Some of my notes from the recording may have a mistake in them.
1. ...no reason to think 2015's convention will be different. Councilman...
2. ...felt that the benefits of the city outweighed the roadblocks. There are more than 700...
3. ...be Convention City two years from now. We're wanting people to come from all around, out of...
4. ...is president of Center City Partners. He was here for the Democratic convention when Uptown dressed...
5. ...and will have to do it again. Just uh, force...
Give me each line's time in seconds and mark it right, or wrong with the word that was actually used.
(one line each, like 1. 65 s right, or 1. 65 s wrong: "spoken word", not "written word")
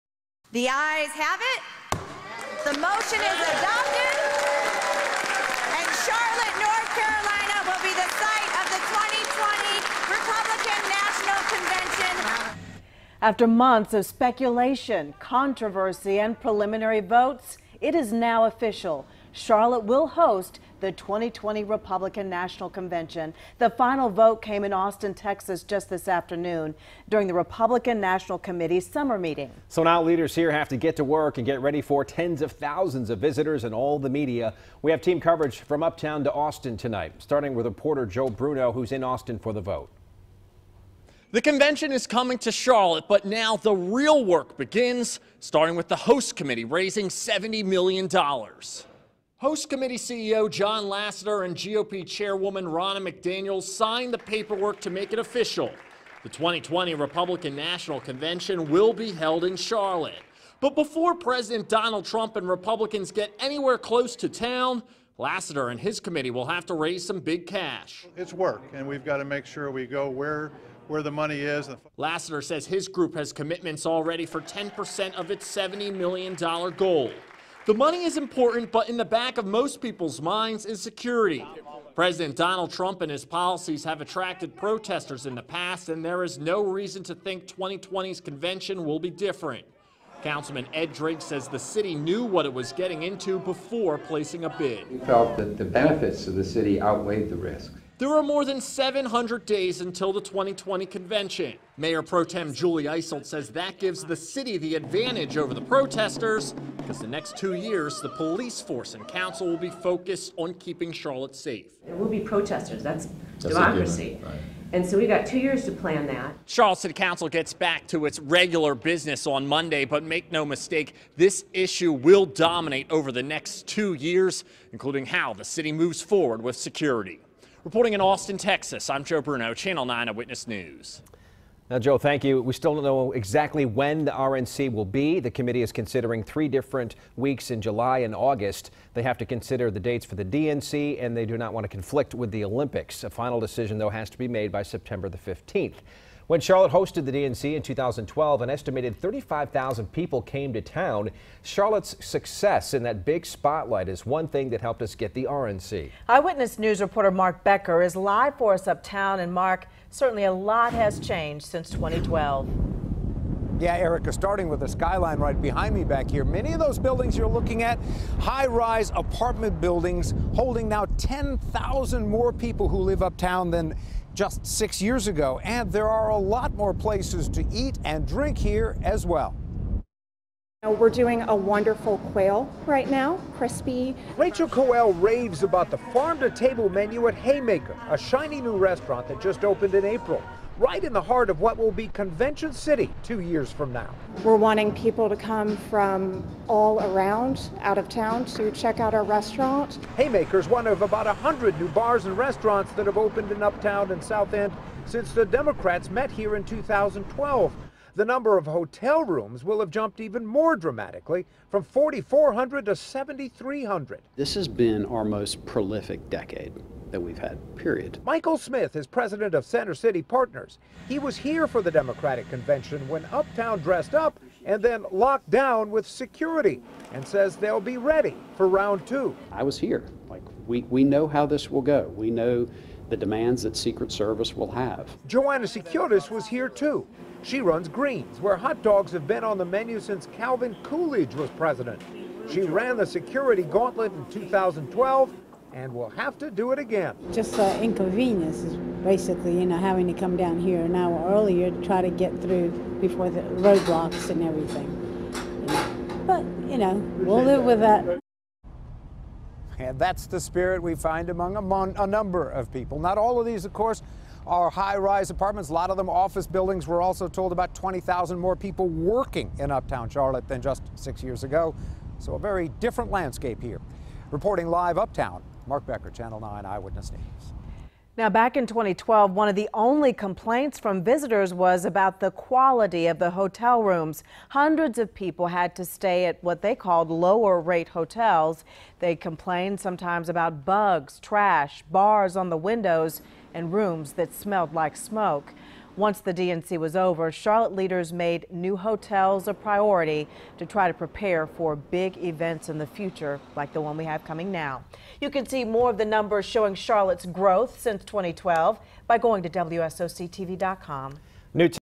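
1. 86 s wrong: "2020", not "2015"
2. 94 s wrong: "risks", not "roadblocks"
3. 191 s right
4. 218 s right
5. 245 s wrong: "inconvenience", not "force".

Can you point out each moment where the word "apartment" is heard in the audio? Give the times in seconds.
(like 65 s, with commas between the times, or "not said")
168 s, 265 s.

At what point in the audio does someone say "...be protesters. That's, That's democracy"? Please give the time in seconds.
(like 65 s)
112 s.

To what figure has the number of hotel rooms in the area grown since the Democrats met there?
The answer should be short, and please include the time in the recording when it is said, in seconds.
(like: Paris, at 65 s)
7,300, at 212 s.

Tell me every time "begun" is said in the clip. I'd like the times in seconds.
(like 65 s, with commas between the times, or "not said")
not said.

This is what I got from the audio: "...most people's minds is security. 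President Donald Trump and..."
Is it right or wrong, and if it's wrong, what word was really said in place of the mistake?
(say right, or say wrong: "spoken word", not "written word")
right.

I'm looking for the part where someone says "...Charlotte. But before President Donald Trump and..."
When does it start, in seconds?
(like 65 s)
59 s.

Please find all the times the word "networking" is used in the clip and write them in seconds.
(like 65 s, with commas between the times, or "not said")
not said.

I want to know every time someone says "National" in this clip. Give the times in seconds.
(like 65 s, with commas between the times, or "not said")
10 s, 22 s, 28 s, 57 s.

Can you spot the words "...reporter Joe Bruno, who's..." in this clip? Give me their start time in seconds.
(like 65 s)
37 s.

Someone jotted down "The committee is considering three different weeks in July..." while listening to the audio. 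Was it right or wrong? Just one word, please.
right.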